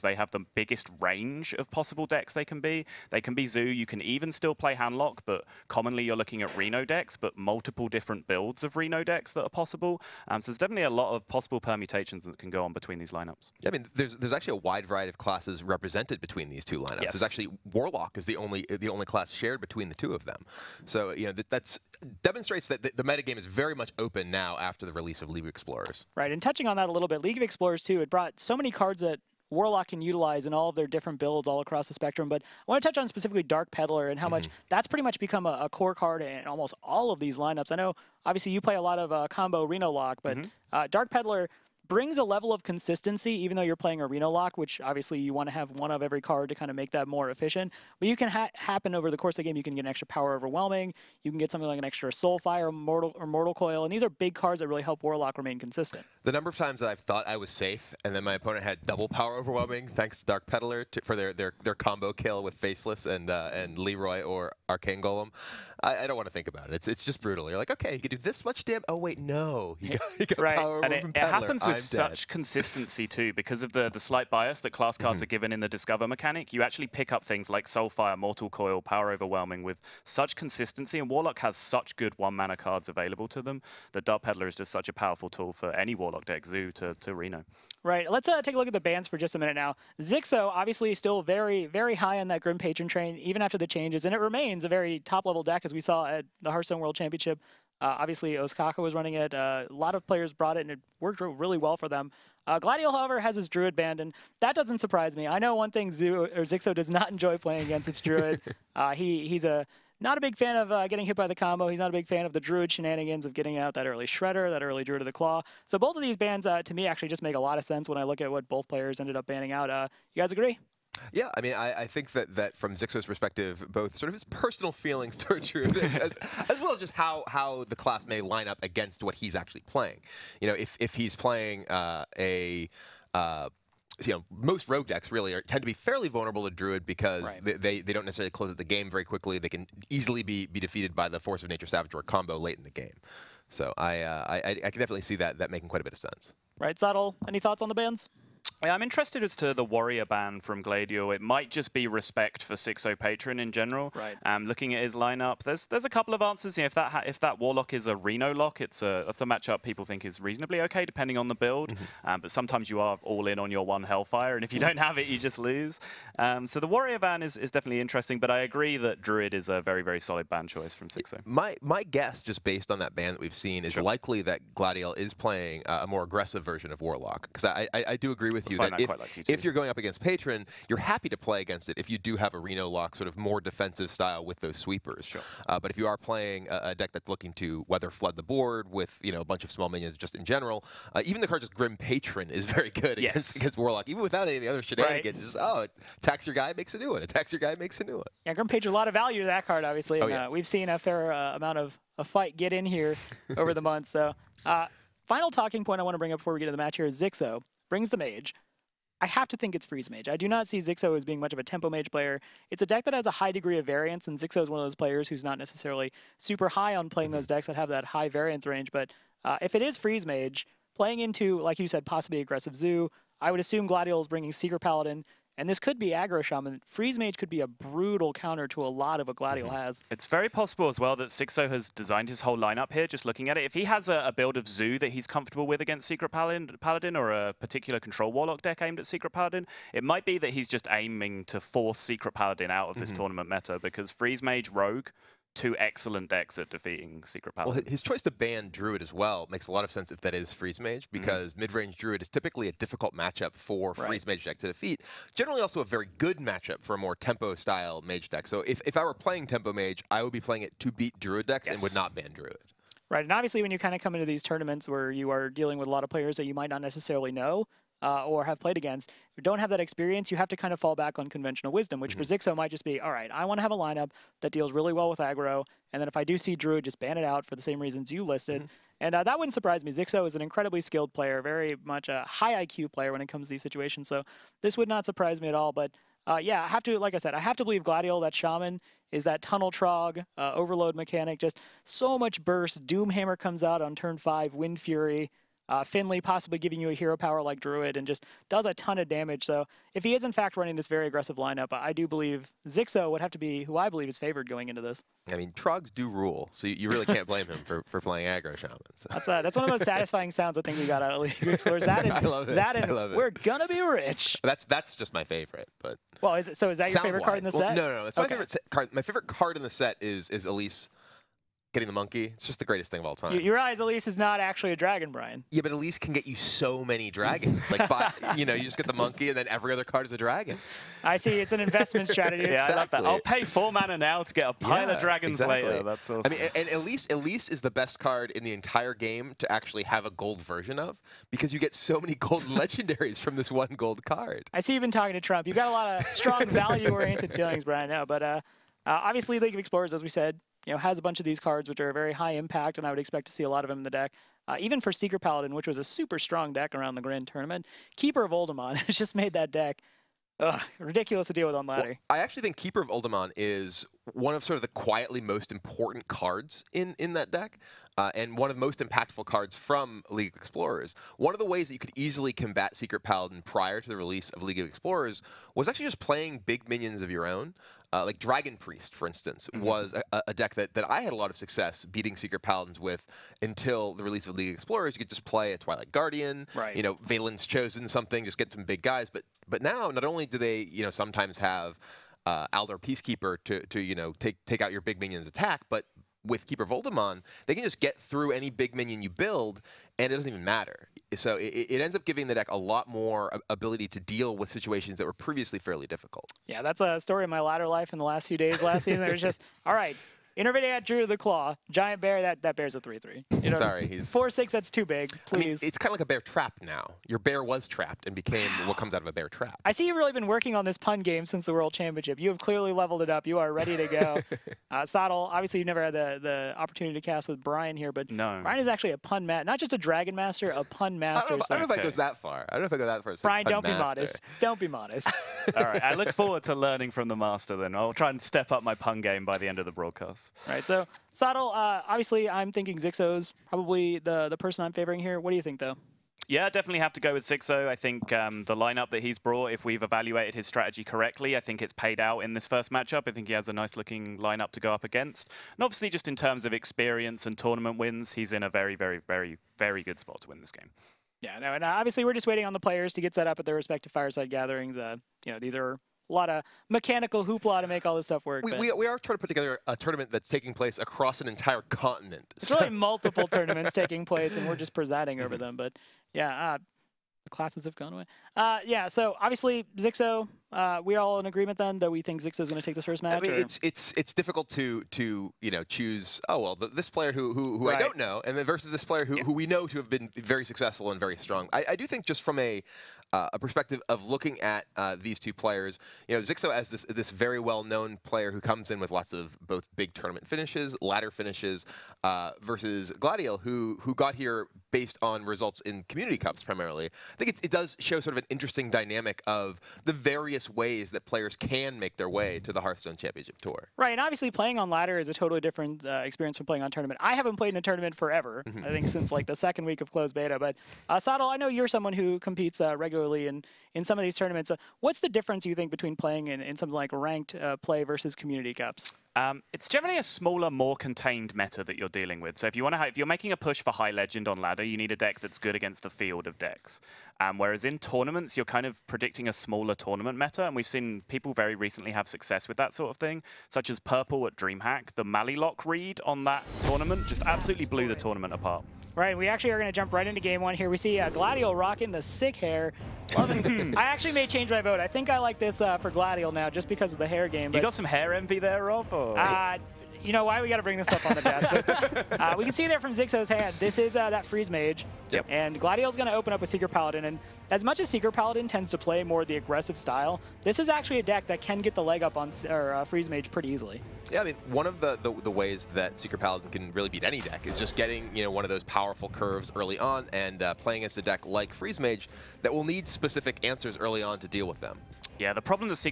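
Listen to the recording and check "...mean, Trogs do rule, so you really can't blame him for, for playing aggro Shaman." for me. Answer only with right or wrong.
right.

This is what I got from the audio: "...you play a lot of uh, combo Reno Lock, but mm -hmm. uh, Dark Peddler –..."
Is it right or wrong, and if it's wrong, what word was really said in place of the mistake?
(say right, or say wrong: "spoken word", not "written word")
right.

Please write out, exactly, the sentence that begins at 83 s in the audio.
The Dark Peddler is just such a powerful tool for any Warlock deck, Zoo to, to Reno.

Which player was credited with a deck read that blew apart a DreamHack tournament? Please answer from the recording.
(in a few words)
Purple.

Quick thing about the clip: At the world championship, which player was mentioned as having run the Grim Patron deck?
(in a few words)
Ostkaka.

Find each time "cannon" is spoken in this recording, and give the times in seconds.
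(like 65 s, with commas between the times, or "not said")
not said.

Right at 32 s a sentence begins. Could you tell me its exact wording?
But I want to touch on specifically Dark Peddler and how mm -hmm.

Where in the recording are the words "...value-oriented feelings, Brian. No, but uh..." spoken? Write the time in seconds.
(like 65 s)
346 s.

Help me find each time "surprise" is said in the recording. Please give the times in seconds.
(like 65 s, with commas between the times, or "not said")
104 s, 279 s, 284 s.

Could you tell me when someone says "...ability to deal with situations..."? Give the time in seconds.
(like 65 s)
403 s.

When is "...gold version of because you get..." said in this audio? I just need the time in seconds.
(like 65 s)
339 s.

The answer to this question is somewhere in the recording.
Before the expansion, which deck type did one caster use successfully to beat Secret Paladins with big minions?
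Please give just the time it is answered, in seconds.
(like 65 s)
377 s.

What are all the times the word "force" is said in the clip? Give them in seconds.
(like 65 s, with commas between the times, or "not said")
141 s, 241 s.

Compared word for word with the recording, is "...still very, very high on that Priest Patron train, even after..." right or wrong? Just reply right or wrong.
wrong.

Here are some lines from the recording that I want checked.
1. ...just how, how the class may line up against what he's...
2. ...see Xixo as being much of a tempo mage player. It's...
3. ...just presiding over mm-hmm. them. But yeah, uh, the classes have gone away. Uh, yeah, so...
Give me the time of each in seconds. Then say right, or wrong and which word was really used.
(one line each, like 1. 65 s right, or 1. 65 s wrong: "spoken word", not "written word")
1. 126 s right
2. 210 s right
3. 474 s right.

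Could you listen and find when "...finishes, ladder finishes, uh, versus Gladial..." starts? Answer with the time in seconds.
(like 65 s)
500 s.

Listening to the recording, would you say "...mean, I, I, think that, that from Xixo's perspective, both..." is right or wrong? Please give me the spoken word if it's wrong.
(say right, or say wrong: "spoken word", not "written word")
right.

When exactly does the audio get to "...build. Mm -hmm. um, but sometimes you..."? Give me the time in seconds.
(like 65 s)
161 s.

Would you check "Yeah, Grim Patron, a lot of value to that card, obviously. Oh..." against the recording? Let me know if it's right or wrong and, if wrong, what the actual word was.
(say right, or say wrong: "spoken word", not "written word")
right.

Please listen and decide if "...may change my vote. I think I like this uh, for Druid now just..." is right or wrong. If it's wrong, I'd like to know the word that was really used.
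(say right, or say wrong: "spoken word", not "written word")
wrong: "Gladial", not "Druid".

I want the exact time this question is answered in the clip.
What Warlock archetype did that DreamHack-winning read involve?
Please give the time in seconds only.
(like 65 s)
544 s.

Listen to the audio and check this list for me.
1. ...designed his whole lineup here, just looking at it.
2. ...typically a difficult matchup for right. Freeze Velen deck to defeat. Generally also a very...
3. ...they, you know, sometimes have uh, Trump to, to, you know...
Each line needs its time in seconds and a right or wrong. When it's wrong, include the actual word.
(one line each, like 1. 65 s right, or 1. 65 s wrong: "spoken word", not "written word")
1. 231 s right
2. 252 s wrong: "Mage", not "Velen"
3. 390 s wrong: "Peacekeeper", not "Trump".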